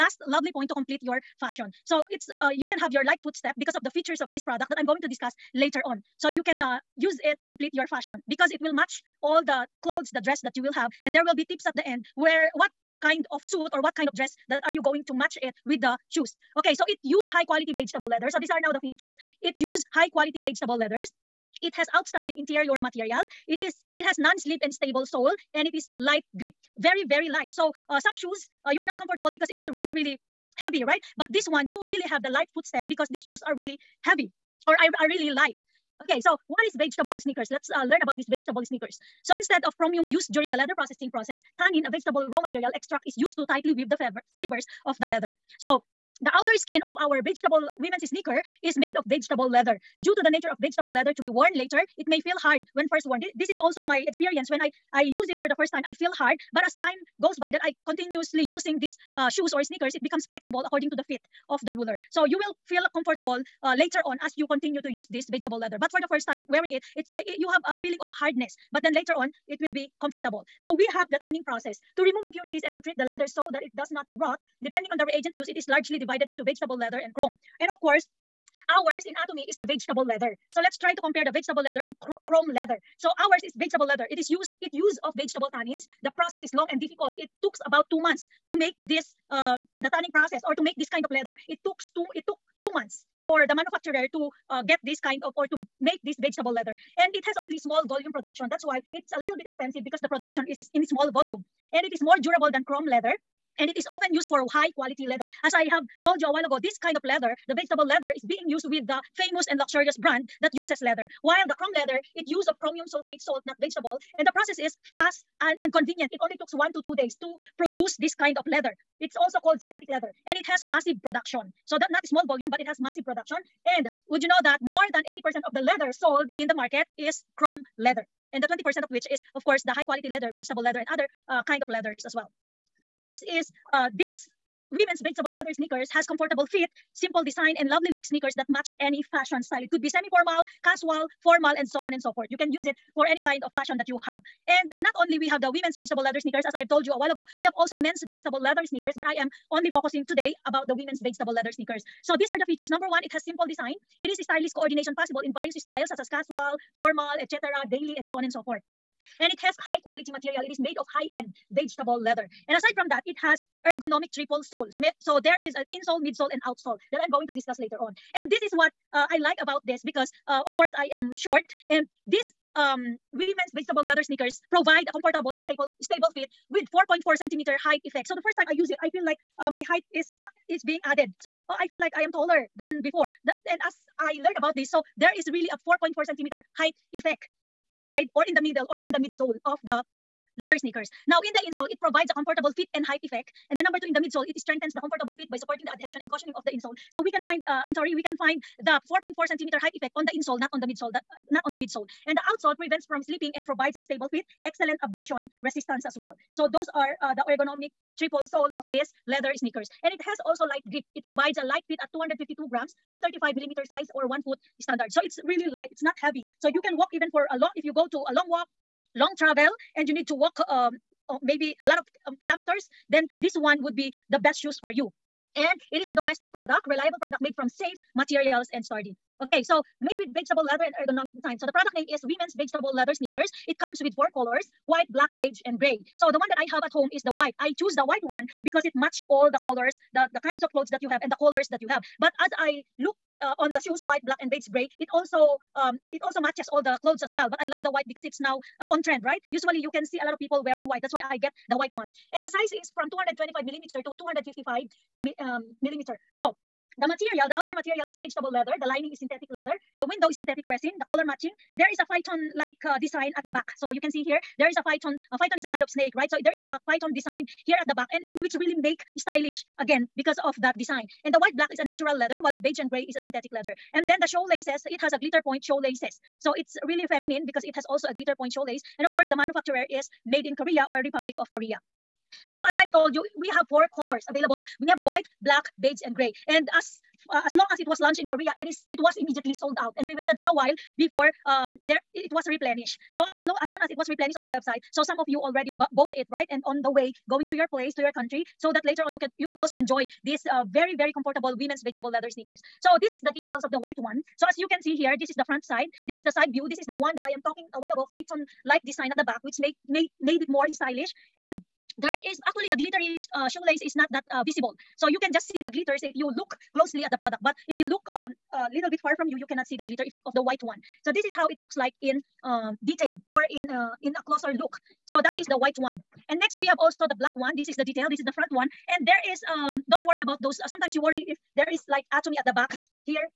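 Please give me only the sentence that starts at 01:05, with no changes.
But for the first time wearing it, it's it, eh, eh, you have a feeling of hardness.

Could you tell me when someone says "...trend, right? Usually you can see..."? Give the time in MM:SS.
04:08.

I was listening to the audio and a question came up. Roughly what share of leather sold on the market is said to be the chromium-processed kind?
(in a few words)
more than 80%.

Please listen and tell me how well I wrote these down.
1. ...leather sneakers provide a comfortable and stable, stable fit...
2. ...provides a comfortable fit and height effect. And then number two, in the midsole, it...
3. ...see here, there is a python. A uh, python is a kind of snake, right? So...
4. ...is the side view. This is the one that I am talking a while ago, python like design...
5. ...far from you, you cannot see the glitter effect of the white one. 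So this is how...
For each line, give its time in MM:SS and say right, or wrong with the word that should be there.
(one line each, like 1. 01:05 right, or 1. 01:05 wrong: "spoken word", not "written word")
1. 02:53 right
2. 03:11 right
3. 04:23 right
4. 05:05 right
5. 05:18 right.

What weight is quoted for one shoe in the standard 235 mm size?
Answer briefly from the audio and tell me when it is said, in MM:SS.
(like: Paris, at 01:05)
252 grams, at 03:31.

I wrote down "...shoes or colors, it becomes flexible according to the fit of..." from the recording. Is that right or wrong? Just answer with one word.
wrong.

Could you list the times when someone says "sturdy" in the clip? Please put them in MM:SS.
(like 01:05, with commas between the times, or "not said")
03:48.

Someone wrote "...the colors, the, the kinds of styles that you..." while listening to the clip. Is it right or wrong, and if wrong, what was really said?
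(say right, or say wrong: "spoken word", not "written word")
wrong: "clothes", not "styles".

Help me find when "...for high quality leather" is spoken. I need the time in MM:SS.
01:44.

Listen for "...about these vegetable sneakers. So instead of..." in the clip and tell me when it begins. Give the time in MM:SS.
00:38.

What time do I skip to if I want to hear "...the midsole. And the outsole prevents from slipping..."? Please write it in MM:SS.
03:21.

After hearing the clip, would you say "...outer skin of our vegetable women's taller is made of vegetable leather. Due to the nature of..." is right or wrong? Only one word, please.
wrong.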